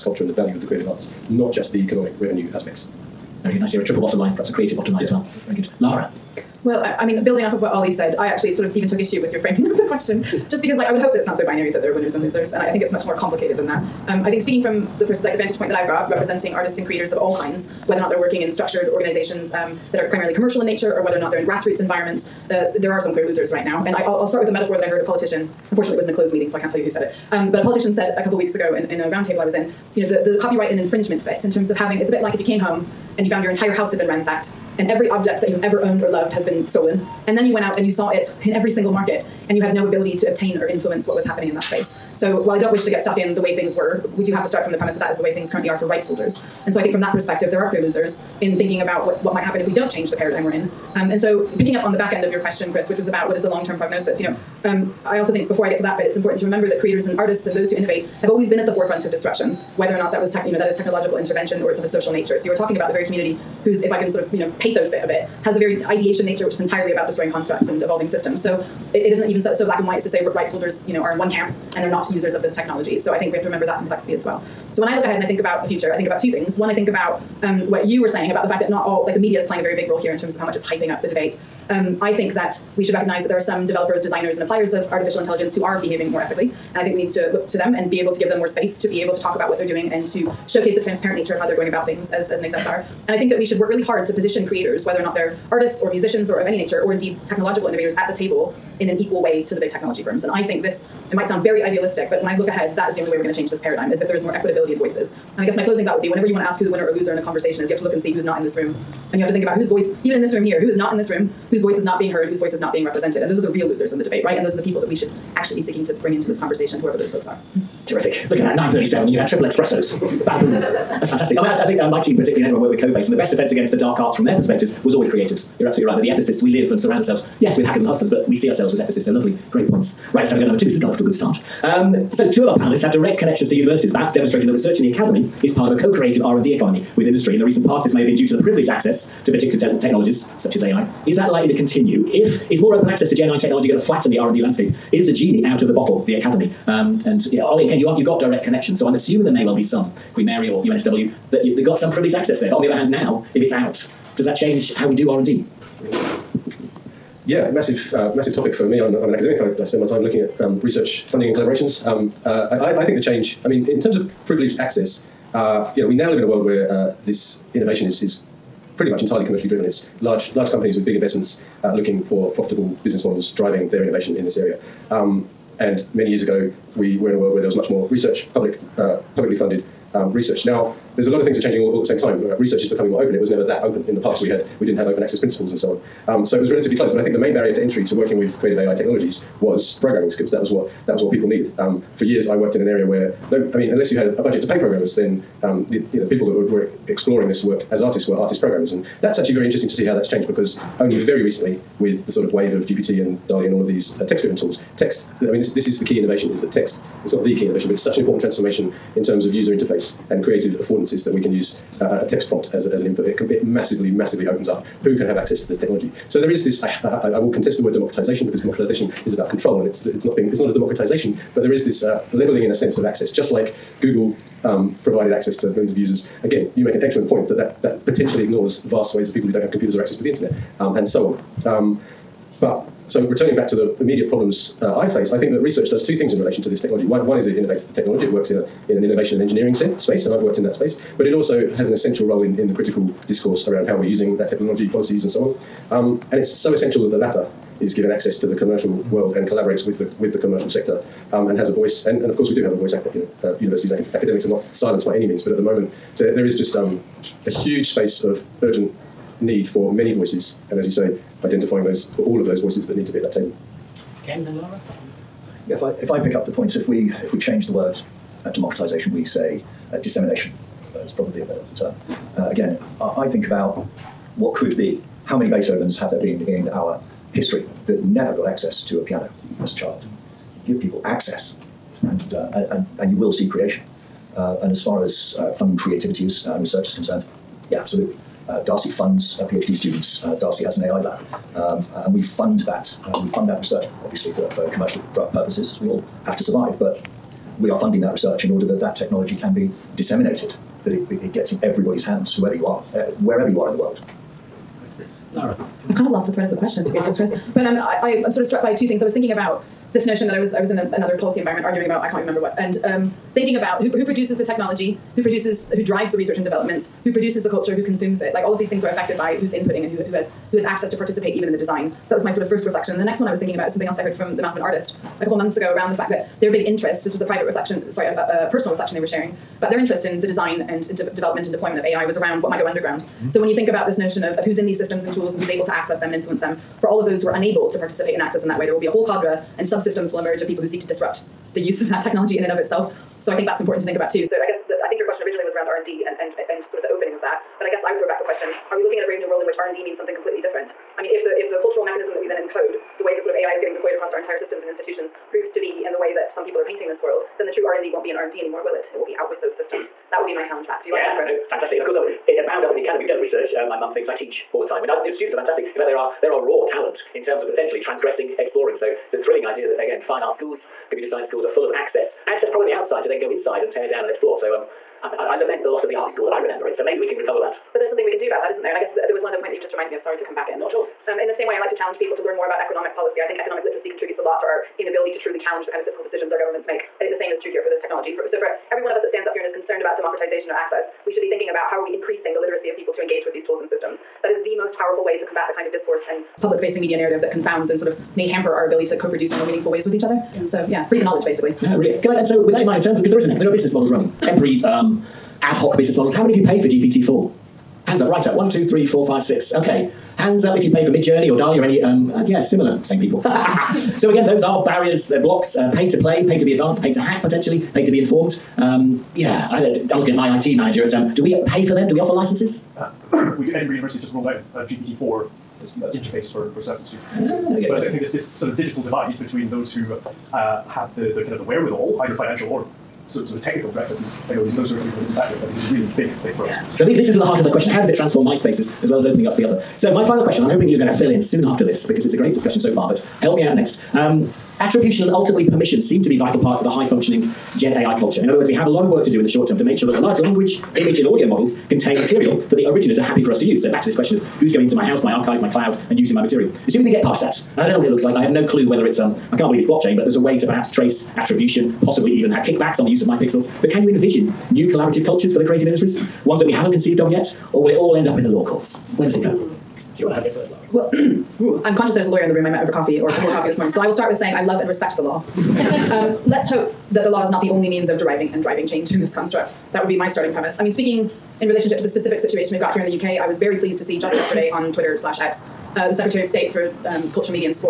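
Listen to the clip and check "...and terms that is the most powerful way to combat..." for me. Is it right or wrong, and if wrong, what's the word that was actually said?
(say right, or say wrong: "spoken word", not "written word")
wrong: "systems", not "terms".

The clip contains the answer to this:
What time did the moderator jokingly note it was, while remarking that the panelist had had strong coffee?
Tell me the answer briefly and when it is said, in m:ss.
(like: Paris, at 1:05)
9.37, at 1:58.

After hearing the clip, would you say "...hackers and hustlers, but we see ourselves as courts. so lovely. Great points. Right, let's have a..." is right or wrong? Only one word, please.
wrong.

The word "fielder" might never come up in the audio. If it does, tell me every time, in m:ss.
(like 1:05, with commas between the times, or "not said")
not said.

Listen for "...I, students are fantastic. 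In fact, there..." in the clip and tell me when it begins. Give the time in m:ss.
6:04.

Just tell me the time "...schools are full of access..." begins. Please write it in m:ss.
6:11.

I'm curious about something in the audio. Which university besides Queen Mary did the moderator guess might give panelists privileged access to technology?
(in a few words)
UNSW.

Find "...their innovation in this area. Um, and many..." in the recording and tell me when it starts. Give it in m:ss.
2:53.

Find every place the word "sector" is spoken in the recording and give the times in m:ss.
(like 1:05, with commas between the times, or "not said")
4:10.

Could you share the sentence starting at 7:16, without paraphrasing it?
So the, this is the heart of the question.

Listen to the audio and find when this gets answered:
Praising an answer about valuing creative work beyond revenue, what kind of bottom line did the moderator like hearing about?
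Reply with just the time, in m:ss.
0:03.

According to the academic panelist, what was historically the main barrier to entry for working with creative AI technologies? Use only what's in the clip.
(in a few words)
Programming skills.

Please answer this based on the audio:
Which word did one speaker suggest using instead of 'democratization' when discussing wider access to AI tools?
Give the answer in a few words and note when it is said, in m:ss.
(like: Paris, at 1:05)
Dissemination, at 4:29.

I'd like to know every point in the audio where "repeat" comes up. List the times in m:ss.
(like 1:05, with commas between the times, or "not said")
not said.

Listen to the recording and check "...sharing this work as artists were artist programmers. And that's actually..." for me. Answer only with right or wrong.
wrong.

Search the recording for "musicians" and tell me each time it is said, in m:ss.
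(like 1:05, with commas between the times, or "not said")
1:35.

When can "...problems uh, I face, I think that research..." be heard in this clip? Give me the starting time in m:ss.
3:54.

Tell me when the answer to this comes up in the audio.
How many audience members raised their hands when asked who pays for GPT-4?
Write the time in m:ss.
6:49.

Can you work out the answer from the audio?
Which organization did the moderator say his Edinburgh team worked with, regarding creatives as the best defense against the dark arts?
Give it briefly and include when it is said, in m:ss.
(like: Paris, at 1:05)
Cobase, at 2:02.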